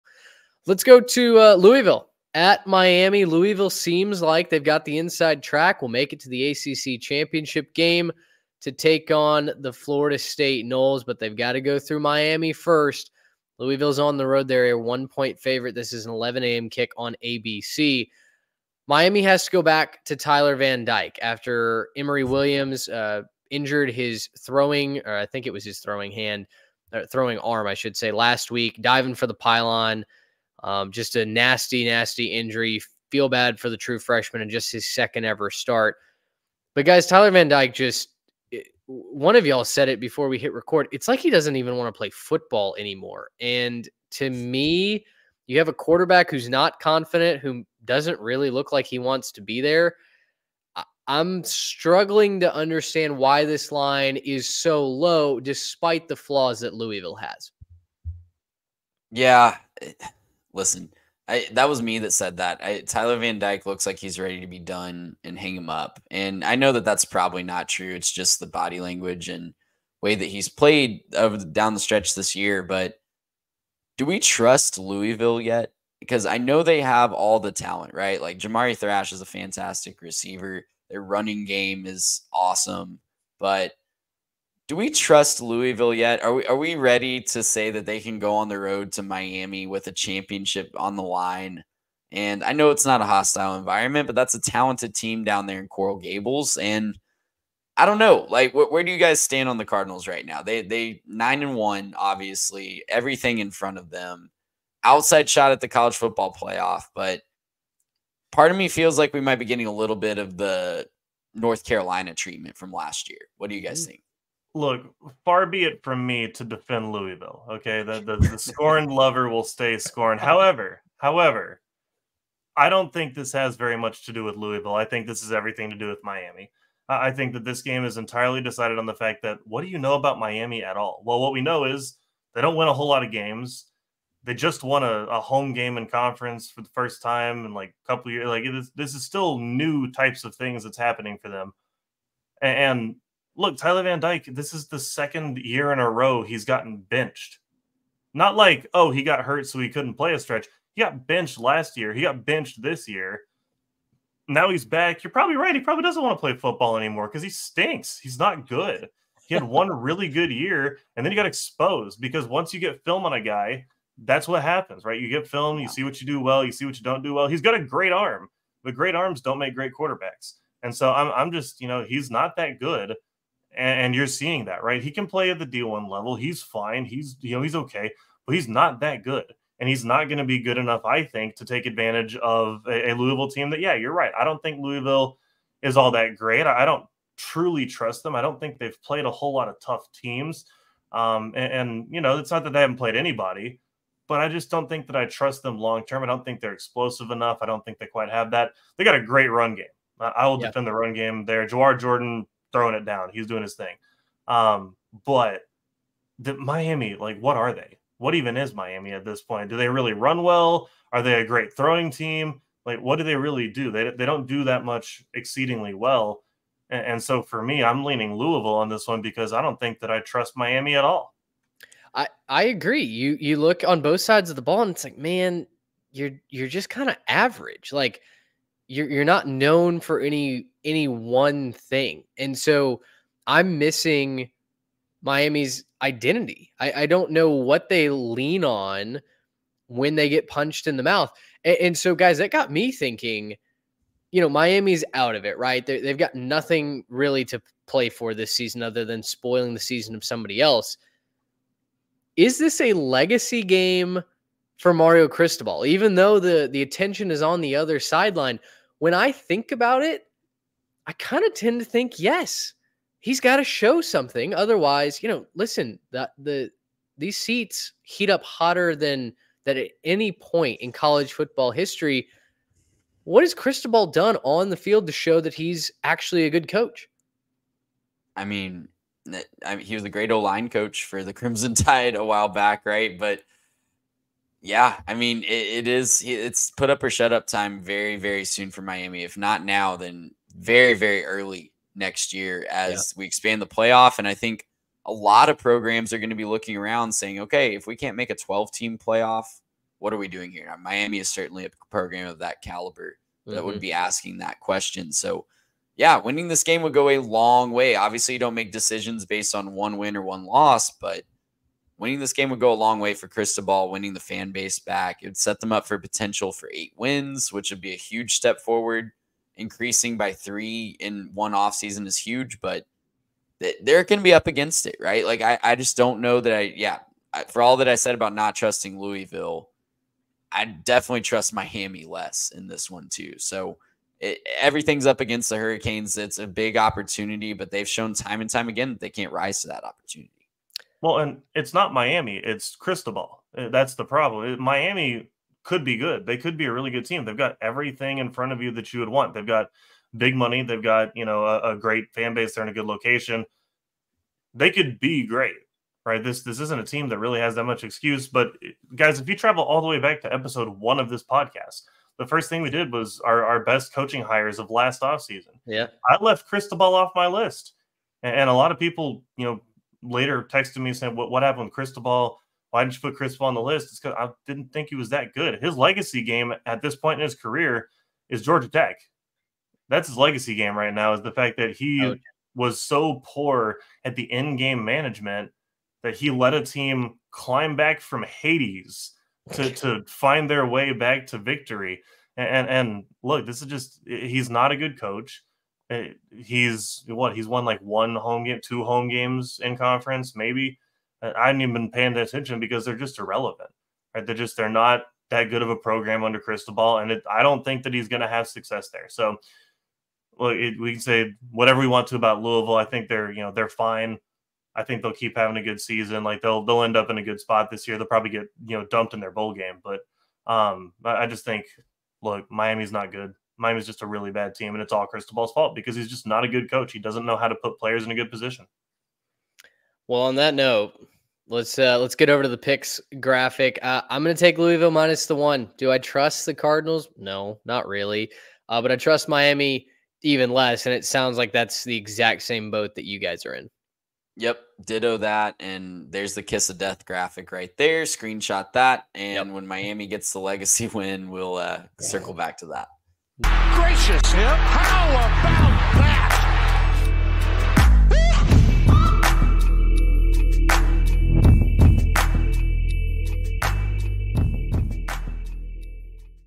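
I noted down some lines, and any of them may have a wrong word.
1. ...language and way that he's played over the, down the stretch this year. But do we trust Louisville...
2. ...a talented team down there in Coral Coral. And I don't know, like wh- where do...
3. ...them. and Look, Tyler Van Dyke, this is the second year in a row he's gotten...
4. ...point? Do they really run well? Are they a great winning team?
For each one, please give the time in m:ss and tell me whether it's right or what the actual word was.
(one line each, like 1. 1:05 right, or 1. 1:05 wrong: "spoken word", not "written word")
1. 1:08 right
2. 1:34 wrong: "Gables", not "Coral"
3. 2:21 right
4. 3:29 wrong: "throwing", not "winning".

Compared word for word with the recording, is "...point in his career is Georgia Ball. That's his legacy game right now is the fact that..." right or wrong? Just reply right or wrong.
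wrong.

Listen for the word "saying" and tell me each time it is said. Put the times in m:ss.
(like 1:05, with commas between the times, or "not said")
4:56, 6:10.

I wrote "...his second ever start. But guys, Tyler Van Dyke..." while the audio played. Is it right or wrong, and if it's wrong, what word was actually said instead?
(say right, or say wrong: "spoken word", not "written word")
right.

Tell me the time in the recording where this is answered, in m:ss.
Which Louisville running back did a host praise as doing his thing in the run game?
3:21.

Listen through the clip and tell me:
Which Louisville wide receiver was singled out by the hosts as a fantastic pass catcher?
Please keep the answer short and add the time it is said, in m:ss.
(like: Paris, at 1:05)
Jamari Thrash, at 1:18.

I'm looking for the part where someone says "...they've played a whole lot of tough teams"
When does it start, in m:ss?
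3:08.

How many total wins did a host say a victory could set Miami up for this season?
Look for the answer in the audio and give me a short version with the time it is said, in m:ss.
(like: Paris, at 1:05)
8, at 5:16.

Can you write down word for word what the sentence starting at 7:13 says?
Uh, I'm going to take Louisville minus the one.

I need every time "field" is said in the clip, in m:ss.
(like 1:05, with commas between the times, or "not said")
4:34.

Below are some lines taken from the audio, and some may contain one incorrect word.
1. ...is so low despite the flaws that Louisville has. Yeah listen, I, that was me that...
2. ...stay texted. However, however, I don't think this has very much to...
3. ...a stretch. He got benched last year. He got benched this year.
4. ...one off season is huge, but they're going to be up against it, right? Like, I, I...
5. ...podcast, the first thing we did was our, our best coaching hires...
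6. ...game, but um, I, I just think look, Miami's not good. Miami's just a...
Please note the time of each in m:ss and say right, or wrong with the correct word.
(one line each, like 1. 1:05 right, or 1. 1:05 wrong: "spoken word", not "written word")
1. 0:54 right
2. 1:59 wrong: "scorned", not "texted"
3. 2:30 right
4. 5:21 right
5. 6:01 right
6. 6:59 right.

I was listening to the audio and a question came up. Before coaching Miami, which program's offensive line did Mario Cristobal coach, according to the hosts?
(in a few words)
Crimson Tide.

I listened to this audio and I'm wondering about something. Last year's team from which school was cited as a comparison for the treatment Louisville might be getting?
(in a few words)
North Carolina.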